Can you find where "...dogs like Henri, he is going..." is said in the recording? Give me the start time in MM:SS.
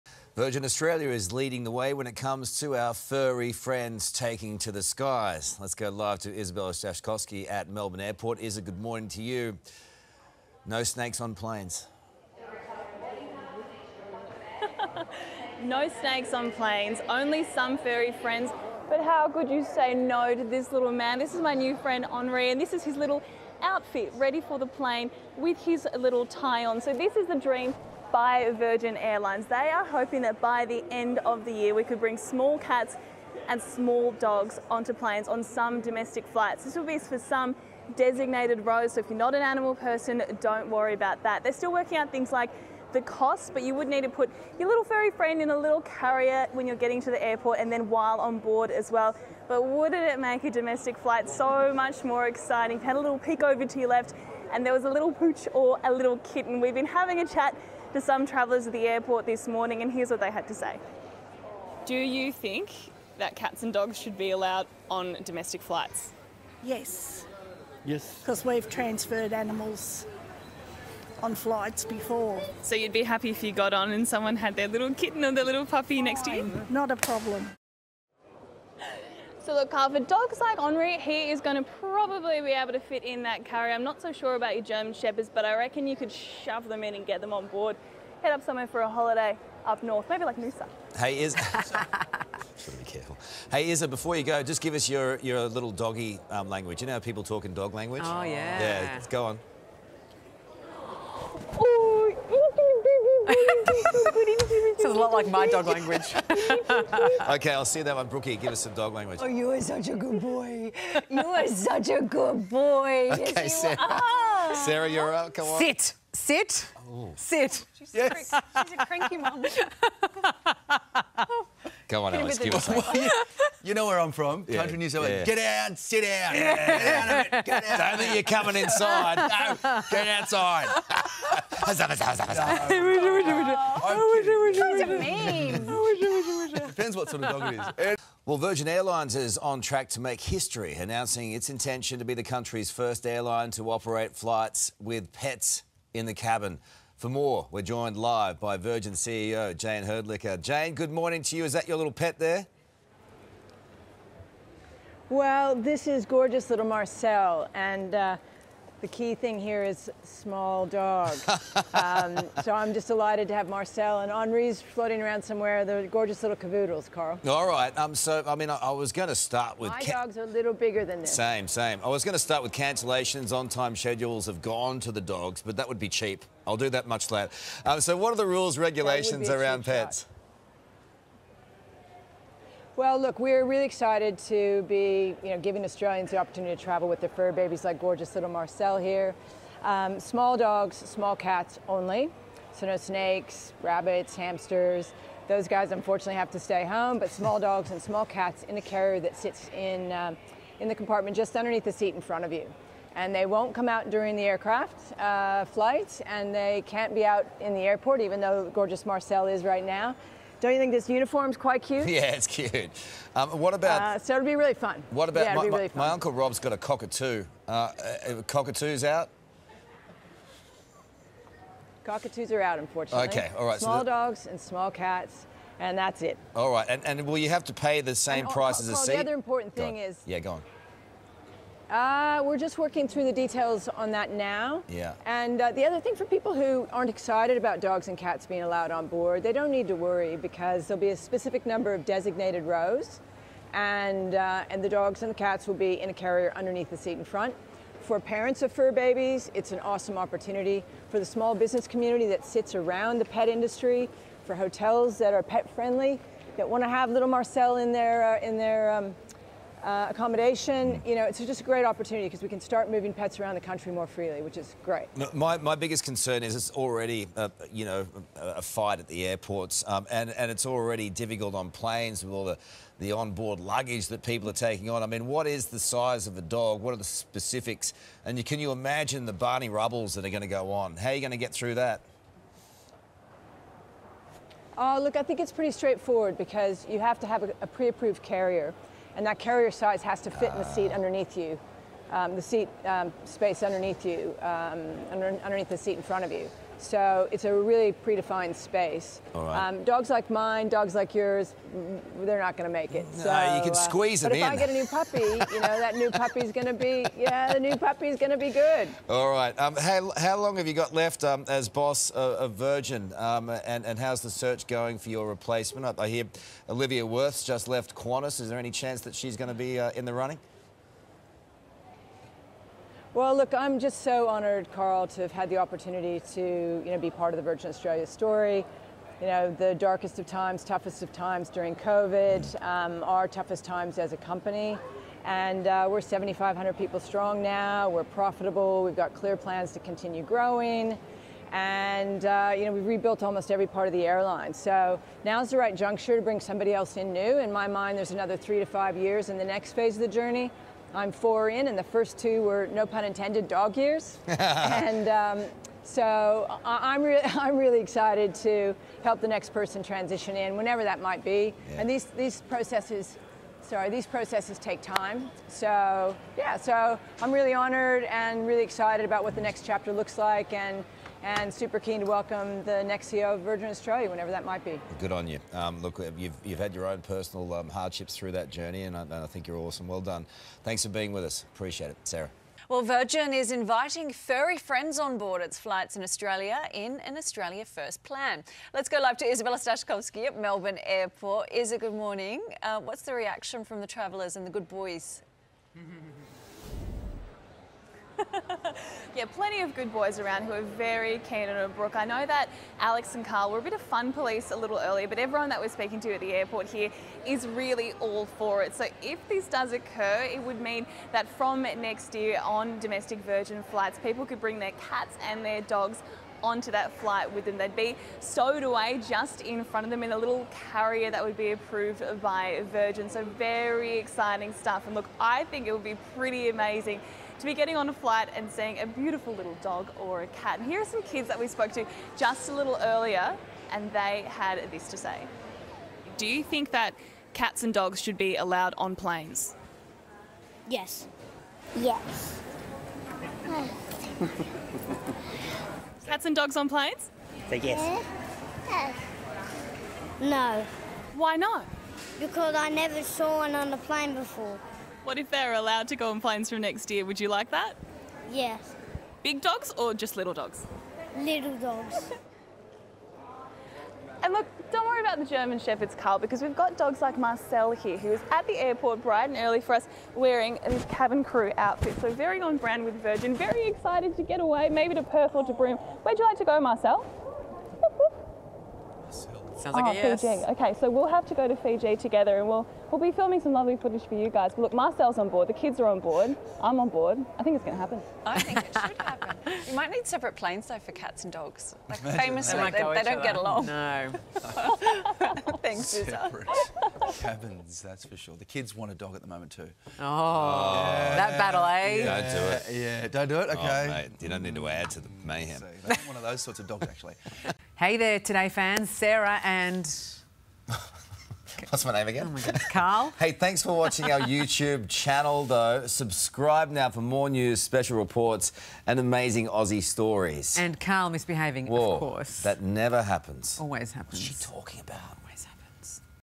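01:19.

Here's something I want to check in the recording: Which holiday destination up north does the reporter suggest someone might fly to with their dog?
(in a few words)
Noosa.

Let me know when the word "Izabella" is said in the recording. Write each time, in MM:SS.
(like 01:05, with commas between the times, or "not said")
00:06, 06:29.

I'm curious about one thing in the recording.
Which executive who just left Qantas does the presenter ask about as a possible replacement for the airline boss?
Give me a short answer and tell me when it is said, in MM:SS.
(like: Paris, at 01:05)
Olivia Wirth, at 05:16.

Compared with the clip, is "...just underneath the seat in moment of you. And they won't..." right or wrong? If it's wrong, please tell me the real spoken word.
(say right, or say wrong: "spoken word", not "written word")
wrong: "front", not "moment".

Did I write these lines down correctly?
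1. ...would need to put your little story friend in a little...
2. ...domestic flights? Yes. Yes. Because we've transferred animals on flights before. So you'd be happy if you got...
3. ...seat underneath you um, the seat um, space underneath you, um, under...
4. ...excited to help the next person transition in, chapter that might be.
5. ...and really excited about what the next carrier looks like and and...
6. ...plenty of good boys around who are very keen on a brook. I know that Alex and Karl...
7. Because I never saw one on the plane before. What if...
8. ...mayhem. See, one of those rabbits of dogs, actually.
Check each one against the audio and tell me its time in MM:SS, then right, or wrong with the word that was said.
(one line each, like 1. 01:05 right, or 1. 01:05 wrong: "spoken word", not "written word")
1. 00:43 wrong: "furry", not "story"
2. 01:05 right
3. 04:50 right
4. 05:57 wrong: "whenever", not "chapter"
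5. 06:07 wrong: "chapter", not "carrier"
6. 06:39 right
7. 07:31 right
8. 08:25 wrong: "sorts", not "rabbits".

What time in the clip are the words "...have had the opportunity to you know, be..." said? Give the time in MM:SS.
05:25.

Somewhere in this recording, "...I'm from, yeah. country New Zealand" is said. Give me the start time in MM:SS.
02:03.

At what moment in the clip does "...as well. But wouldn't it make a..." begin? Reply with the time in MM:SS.
00:48.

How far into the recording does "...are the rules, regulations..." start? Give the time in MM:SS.
02:58.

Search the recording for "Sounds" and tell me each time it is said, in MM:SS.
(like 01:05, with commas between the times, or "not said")
01:44, 07:59.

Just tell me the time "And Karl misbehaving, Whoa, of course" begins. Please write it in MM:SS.
08:40.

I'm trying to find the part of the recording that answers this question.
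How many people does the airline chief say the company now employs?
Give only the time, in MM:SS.
05:35.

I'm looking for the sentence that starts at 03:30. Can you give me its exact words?
Don't you think this uniform's quite cute?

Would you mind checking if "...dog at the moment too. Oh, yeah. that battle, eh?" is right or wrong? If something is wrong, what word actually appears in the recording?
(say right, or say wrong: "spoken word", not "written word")
right.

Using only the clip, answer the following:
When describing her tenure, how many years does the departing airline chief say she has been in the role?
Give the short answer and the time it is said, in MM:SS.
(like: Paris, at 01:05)
4, at 05:50.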